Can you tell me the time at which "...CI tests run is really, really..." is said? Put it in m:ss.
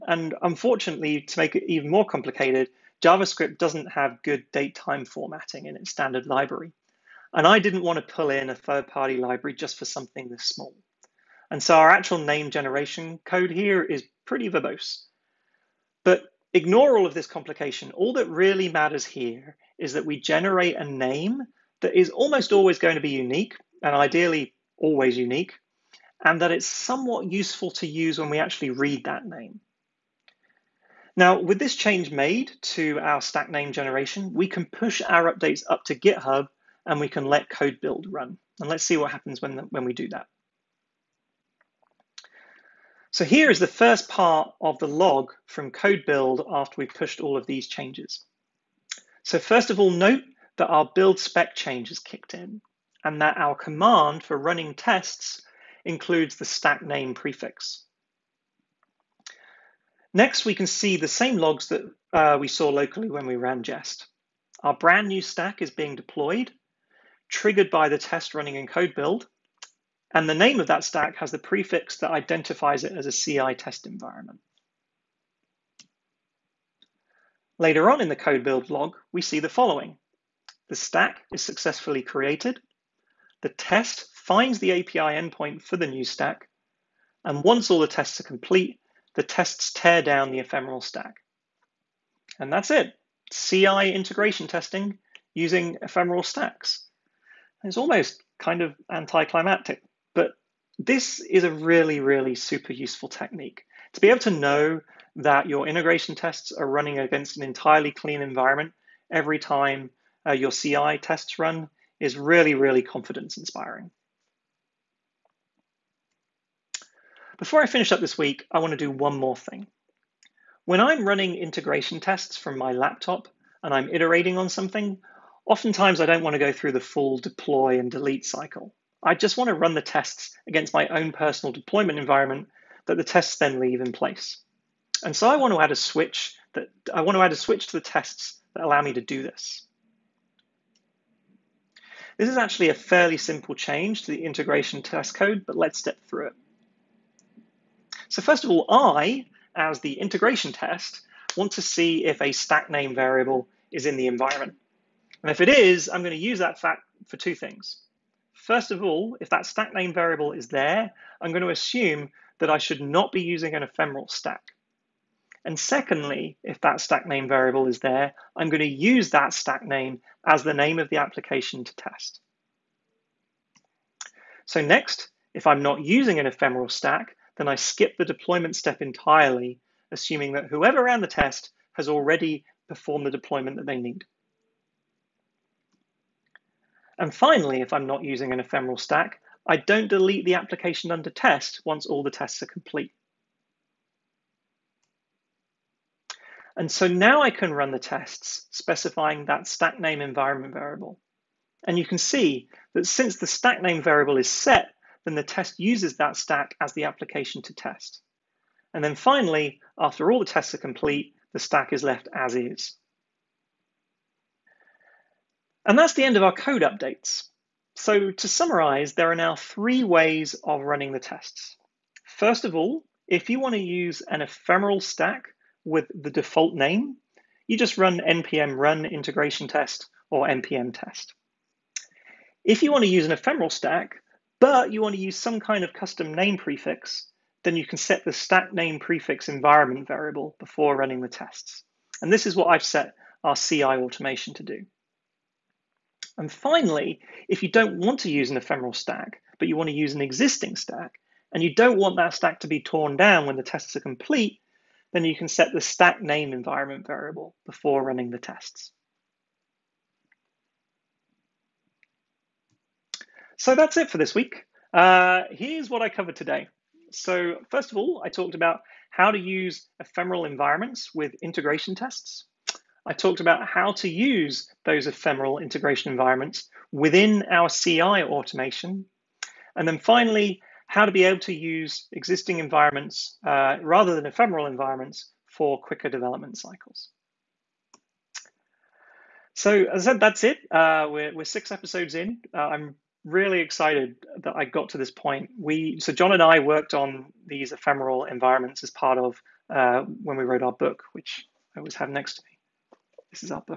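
1:50.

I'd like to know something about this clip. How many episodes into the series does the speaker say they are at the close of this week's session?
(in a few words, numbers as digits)
6.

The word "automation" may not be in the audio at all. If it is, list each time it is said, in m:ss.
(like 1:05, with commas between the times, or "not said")
4:03, 4:37.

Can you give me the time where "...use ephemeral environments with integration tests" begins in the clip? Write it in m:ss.
4:29.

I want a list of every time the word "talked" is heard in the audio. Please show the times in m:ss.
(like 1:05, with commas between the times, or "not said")
4:28, 4:32.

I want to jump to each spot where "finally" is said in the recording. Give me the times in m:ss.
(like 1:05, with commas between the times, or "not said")
3:07, 3:28, 4:06, 4:39.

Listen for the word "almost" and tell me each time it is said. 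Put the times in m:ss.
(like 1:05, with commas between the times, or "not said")
0:22, 1:37.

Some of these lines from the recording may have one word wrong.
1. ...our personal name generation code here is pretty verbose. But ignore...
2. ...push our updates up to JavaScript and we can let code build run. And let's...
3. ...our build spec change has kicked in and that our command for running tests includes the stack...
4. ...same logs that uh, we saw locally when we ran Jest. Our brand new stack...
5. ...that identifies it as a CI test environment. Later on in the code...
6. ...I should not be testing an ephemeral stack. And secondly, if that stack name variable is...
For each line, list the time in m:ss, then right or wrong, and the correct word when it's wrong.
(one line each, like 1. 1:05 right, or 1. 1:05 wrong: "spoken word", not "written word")
1. 0:11 wrong: "actual", not "personal"
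2. 0:34 wrong: "GitHub", not "JavaScript"
3. 0:50 right
4. 1:01 right
5. 1:11 right
6. 2:42 wrong: "using", not "testing".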